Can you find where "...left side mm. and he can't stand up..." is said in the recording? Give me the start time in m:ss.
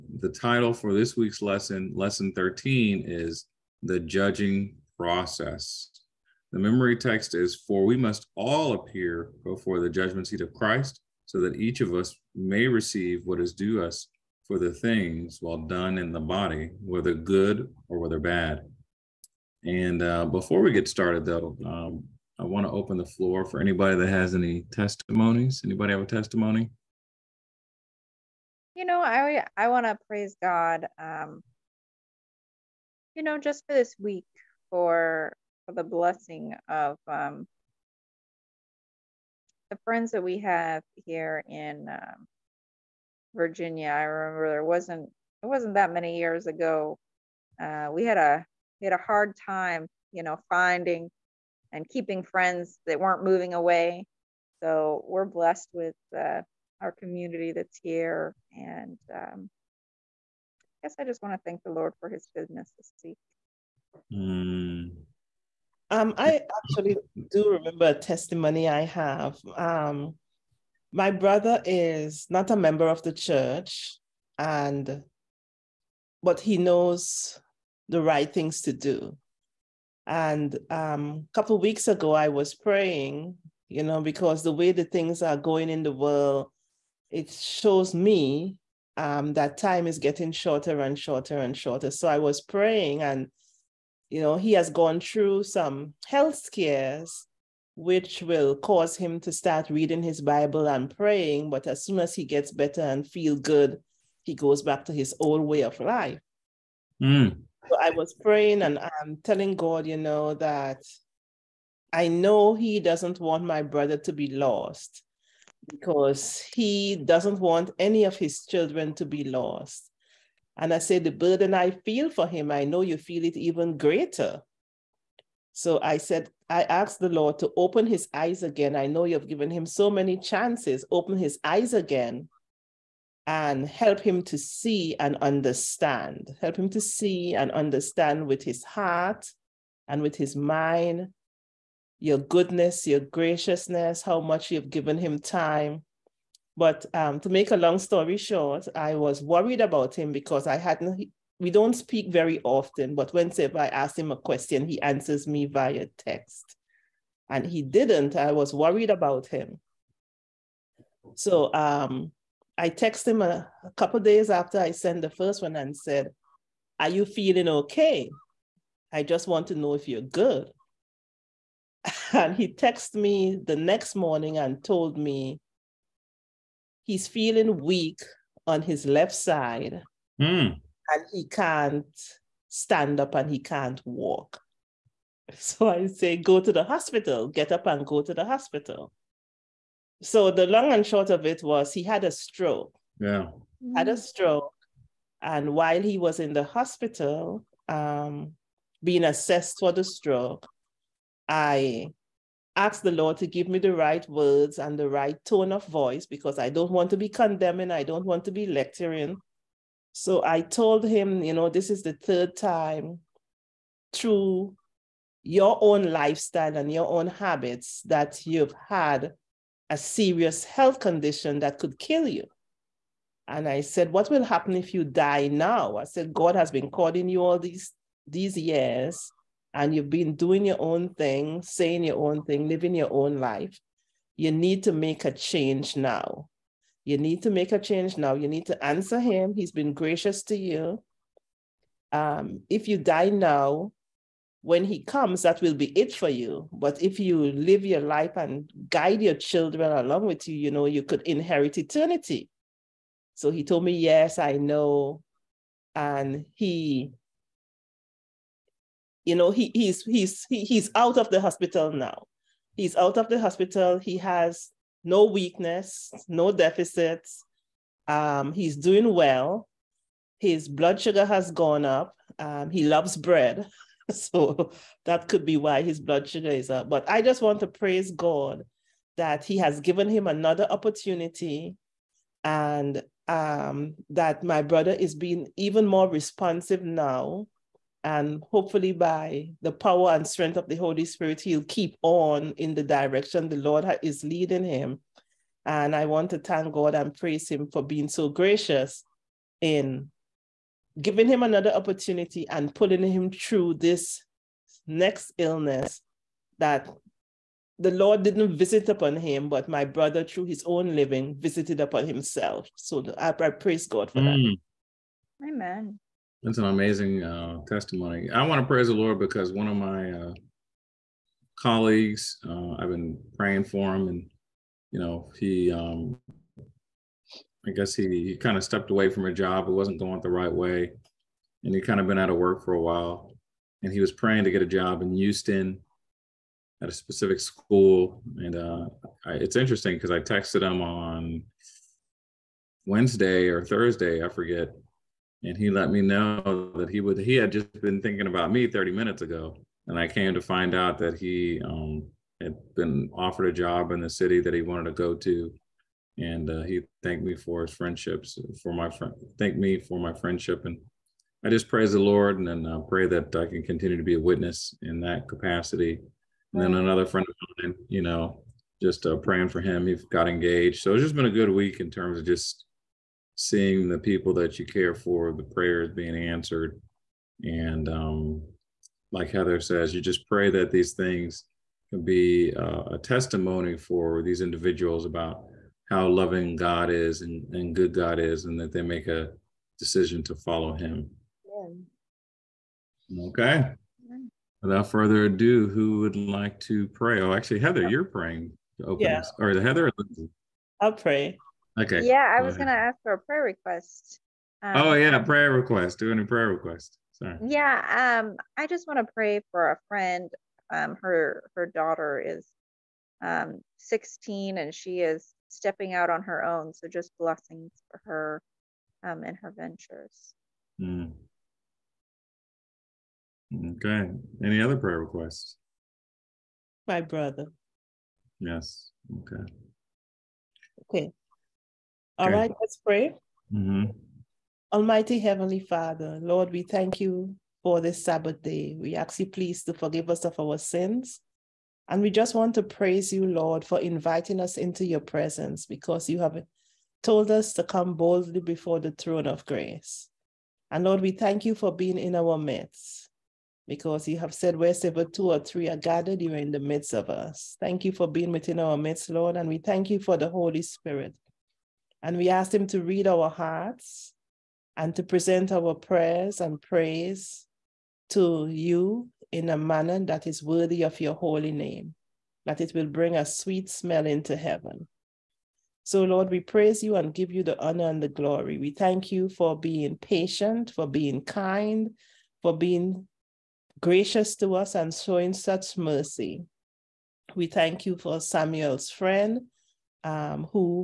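2:58.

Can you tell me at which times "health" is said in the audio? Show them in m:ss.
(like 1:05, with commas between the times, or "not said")
1:36, 3:40.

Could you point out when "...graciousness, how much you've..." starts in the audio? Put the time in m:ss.
2:22.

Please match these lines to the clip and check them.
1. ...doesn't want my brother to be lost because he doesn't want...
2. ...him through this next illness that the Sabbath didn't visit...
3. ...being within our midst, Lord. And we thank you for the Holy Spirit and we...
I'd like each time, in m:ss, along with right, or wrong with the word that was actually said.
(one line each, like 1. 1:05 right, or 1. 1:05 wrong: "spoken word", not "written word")
1. 1:52 right
2. 5:02 wrong: "Lord", not "Sabbath"
3. 7:37 right.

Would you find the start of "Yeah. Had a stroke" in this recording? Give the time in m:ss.
3:12.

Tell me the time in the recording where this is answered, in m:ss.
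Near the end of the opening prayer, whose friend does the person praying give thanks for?
8:07.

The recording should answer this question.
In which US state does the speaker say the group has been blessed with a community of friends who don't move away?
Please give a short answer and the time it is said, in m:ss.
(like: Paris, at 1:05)
Virginia, at 0:43.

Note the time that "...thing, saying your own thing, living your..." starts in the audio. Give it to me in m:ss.
3:50.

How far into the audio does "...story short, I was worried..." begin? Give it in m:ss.
2:27.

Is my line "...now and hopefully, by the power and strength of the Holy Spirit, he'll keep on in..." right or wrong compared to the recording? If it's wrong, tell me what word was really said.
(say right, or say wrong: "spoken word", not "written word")
right.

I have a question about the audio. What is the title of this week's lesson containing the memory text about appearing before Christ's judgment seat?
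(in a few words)
The Judging Process.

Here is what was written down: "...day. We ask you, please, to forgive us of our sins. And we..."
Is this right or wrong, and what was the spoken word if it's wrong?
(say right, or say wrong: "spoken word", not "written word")
right.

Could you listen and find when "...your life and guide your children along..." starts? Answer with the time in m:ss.
4:07.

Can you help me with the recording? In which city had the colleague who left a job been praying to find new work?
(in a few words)
Houston.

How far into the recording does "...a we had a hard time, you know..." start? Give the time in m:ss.
0:48.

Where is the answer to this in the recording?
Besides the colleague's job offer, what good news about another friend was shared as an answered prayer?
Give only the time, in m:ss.
6:10.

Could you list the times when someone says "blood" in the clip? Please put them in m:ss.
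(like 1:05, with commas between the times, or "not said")
4:30, 4:35.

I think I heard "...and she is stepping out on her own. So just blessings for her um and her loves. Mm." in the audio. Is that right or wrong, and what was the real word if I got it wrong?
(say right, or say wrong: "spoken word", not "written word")
wrong: "ventures", not "loves".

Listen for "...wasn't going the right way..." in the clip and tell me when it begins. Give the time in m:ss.
5:29.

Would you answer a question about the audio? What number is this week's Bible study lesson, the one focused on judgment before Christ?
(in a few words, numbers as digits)
13.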